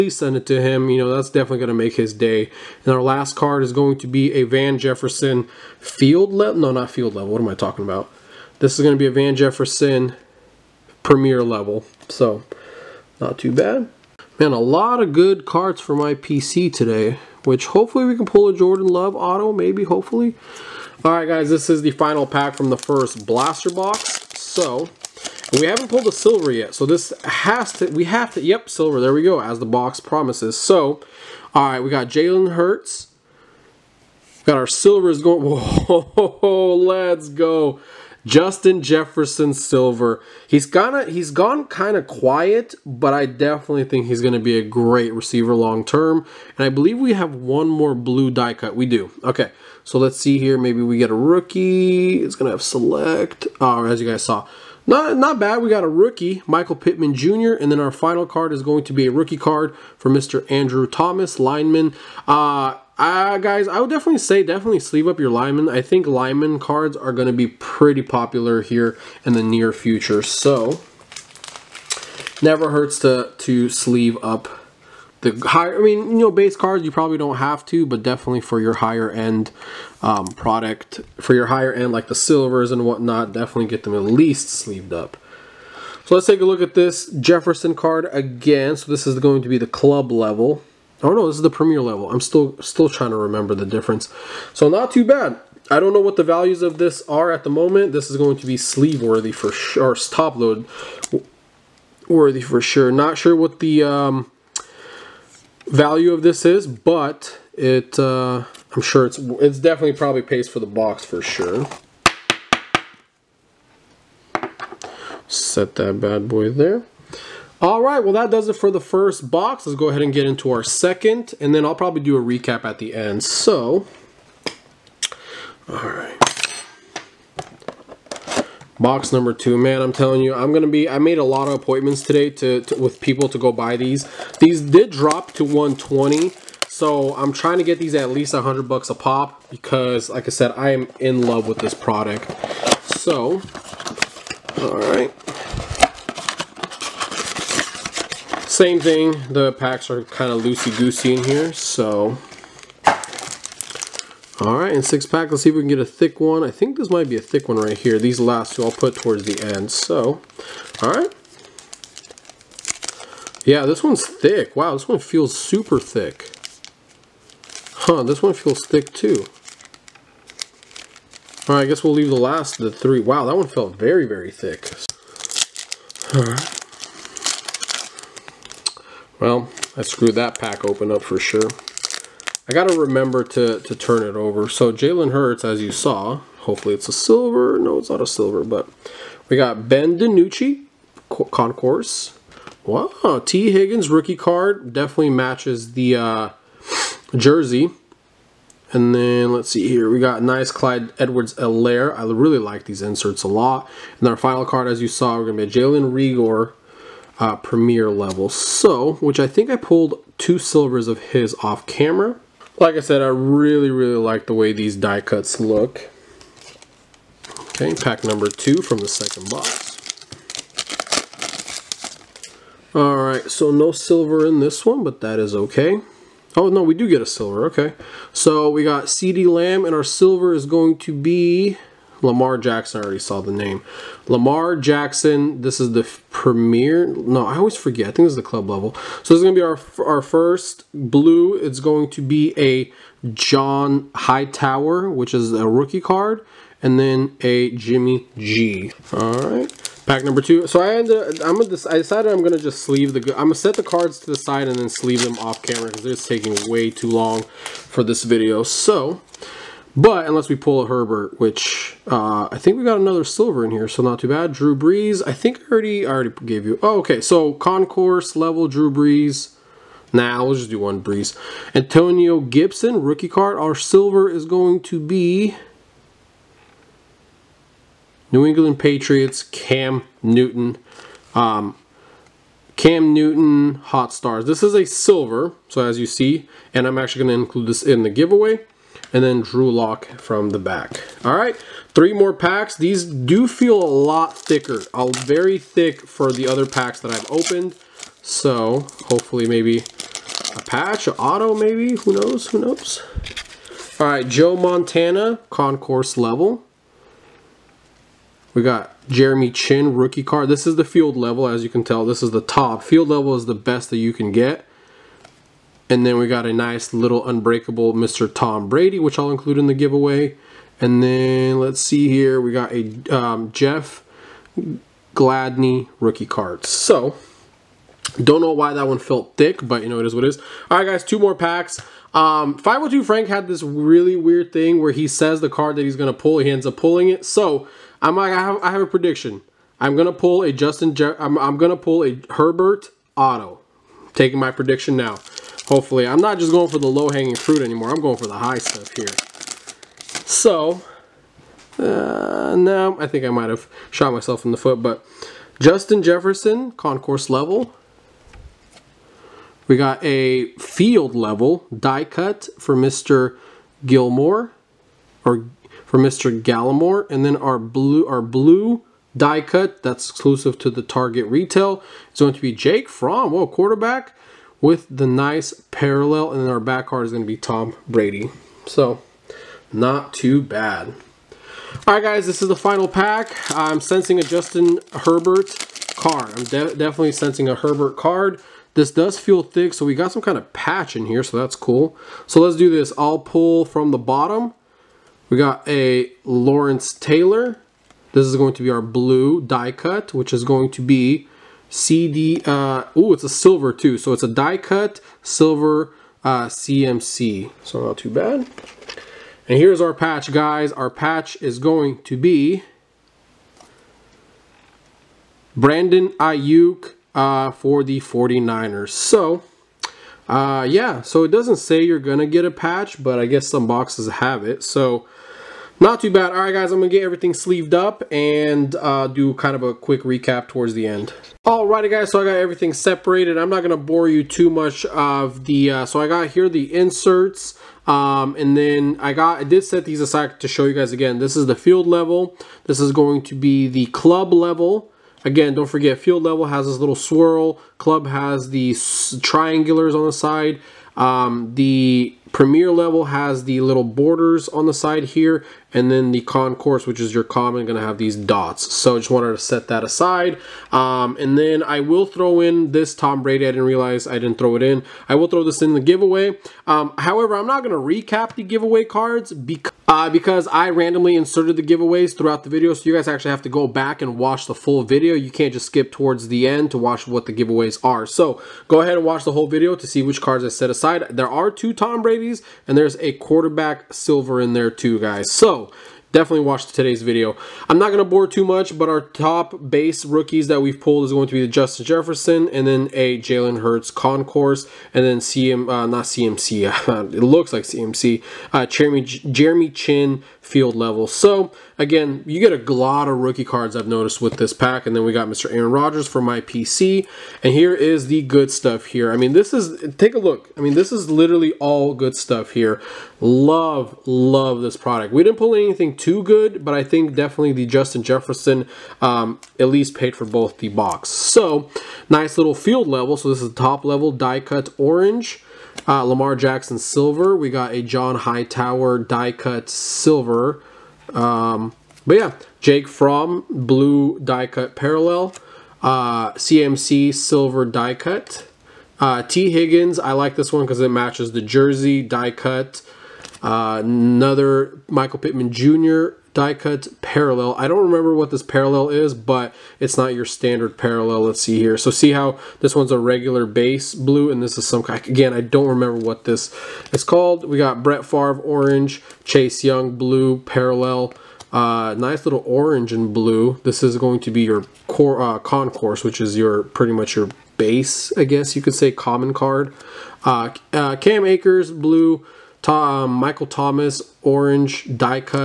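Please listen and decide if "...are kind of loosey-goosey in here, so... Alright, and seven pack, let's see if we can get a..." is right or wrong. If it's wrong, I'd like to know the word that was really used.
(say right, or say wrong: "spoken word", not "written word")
wrong: "six", not "seven".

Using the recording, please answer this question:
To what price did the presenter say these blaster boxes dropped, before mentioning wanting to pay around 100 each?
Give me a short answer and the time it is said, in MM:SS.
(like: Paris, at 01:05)
120, at 02:15.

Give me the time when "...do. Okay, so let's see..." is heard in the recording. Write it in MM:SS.
00:48.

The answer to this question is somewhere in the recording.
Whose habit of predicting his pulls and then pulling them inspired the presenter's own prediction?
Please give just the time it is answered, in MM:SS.
05:32.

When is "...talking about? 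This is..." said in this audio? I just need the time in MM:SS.
00:07.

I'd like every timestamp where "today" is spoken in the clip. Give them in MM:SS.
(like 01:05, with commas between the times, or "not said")
00:16, 02:12, 08:06.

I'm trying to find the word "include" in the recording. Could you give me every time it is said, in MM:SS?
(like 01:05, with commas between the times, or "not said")
04:47, 05:19.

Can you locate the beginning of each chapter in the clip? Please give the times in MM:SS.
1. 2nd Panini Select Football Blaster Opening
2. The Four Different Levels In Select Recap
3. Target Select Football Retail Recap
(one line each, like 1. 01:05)
1. 01:57
2. 07:17
3. 08:07.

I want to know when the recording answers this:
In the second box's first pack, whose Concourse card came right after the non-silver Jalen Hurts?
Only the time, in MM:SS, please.
03:09.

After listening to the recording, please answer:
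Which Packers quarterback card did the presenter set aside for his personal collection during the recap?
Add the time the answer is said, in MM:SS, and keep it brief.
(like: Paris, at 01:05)
Aaron Rodgers, at 08:25.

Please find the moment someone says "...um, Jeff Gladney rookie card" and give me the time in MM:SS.
05:22.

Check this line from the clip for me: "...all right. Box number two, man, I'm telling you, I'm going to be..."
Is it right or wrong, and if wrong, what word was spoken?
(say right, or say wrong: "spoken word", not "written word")
right.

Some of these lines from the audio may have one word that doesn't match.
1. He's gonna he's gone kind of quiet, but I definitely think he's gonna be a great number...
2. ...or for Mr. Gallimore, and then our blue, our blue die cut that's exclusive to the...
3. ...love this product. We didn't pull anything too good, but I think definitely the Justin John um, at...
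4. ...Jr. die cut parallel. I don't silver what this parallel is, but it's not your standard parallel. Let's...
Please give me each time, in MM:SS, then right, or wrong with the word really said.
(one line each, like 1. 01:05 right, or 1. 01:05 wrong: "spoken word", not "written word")
1. 00:40 wrong: "receiver", not "number"
2. 06:05 right
3. 08:33 wrong: "Jefferson", not "John"
4. 09:05 wrong: "remember", not "silver".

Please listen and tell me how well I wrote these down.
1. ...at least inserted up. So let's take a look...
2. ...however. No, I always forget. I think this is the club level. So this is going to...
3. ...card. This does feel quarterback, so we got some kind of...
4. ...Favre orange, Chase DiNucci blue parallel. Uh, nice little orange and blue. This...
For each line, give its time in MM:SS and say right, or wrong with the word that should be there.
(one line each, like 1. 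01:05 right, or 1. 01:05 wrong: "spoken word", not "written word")
1. 01:23 wrong: "sleeved", not "inserted"
2. 03:56 wrong: "premier", not "however"
3. 06:27 wrong: "thick", not "quarterback"
4. 09:17 wrong: "Young", not "DiNucci".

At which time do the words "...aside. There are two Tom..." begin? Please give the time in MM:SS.
08:00.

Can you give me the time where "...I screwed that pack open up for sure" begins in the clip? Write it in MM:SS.
02:59.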